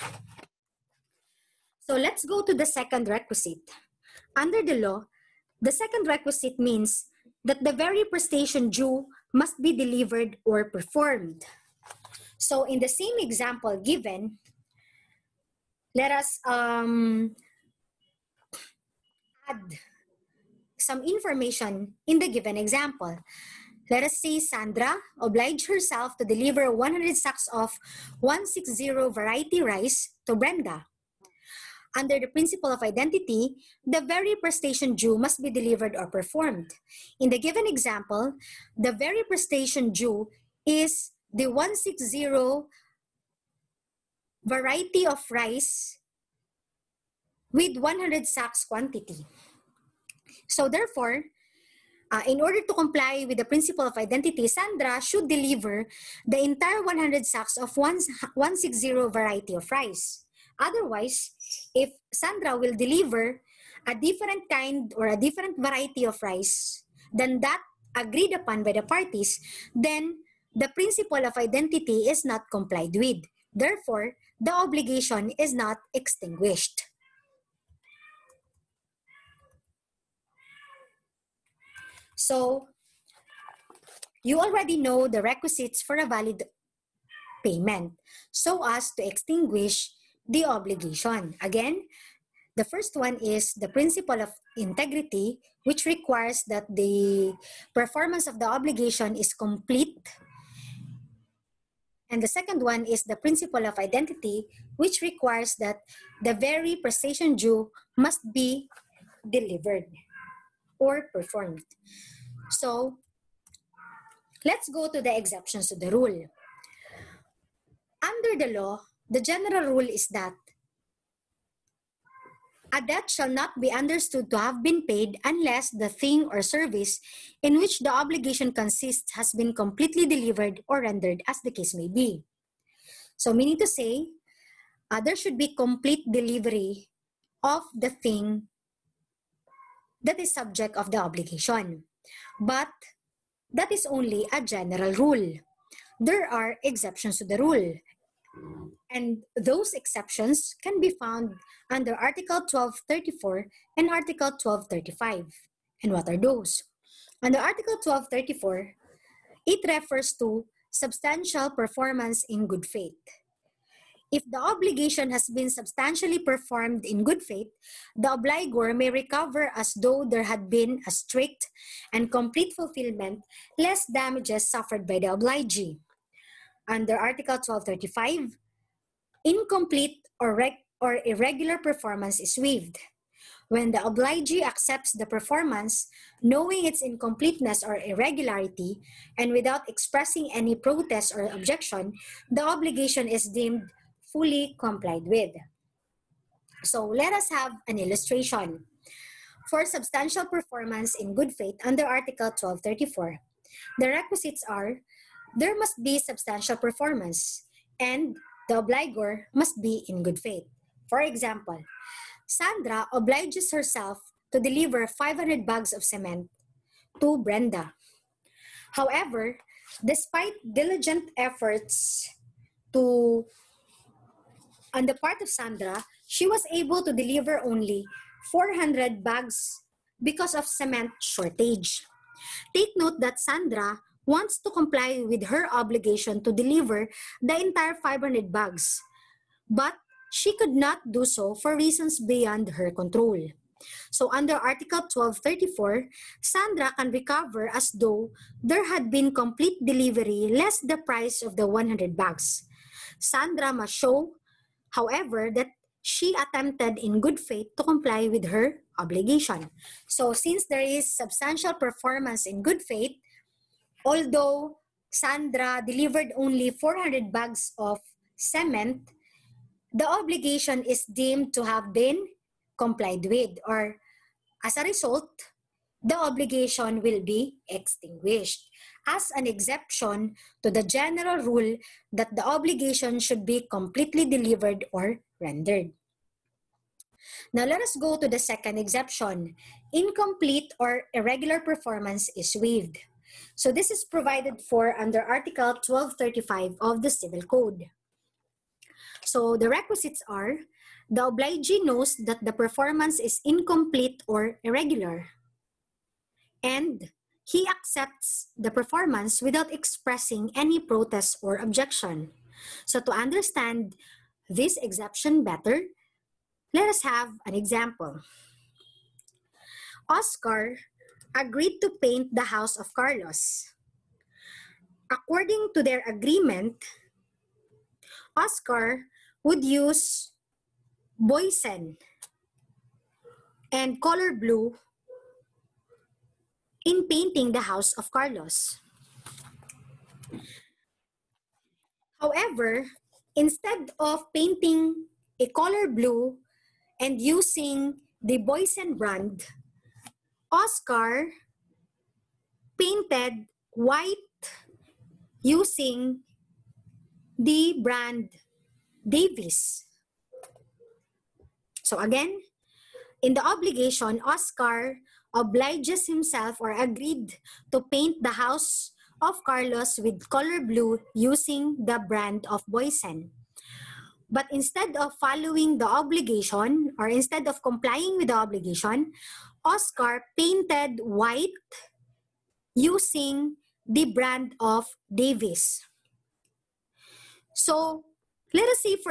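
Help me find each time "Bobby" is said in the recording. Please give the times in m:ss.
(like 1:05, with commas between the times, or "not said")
not said.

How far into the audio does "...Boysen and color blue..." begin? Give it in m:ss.
5:30.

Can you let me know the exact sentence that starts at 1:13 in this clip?
Therefore, the obligation is not extinguished.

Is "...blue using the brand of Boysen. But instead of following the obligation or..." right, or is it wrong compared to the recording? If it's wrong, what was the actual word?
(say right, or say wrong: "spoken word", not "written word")
right.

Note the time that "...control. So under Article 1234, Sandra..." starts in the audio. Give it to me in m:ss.
4:02.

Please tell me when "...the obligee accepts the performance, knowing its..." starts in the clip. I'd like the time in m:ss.
3:03.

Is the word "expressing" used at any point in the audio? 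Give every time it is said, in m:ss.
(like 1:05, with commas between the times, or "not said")
3:09, 5:09.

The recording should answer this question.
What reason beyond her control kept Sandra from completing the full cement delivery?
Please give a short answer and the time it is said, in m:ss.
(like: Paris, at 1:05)
cement shortage, at 3:50.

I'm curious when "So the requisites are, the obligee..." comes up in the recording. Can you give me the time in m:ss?
4:59.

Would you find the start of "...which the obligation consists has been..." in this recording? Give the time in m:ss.
2:07.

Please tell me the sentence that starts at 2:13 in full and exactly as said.
So, meaning to say, uh, there should be complete delivery of the thing that is subject of the obligation.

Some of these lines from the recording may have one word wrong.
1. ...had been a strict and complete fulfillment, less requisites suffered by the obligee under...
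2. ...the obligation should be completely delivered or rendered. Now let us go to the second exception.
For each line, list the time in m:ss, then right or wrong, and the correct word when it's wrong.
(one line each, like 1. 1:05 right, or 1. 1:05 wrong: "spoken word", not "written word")
1. 2:50 wrong: "damages", not "requisites"
2. 4:42 right.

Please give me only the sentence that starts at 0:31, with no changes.
Under the principle of identity, the very prestation due must be delivered or performed.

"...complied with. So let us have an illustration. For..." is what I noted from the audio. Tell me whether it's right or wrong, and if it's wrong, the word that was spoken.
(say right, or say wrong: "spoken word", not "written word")
right.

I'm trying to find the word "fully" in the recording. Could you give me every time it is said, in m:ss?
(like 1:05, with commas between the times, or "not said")
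3:14.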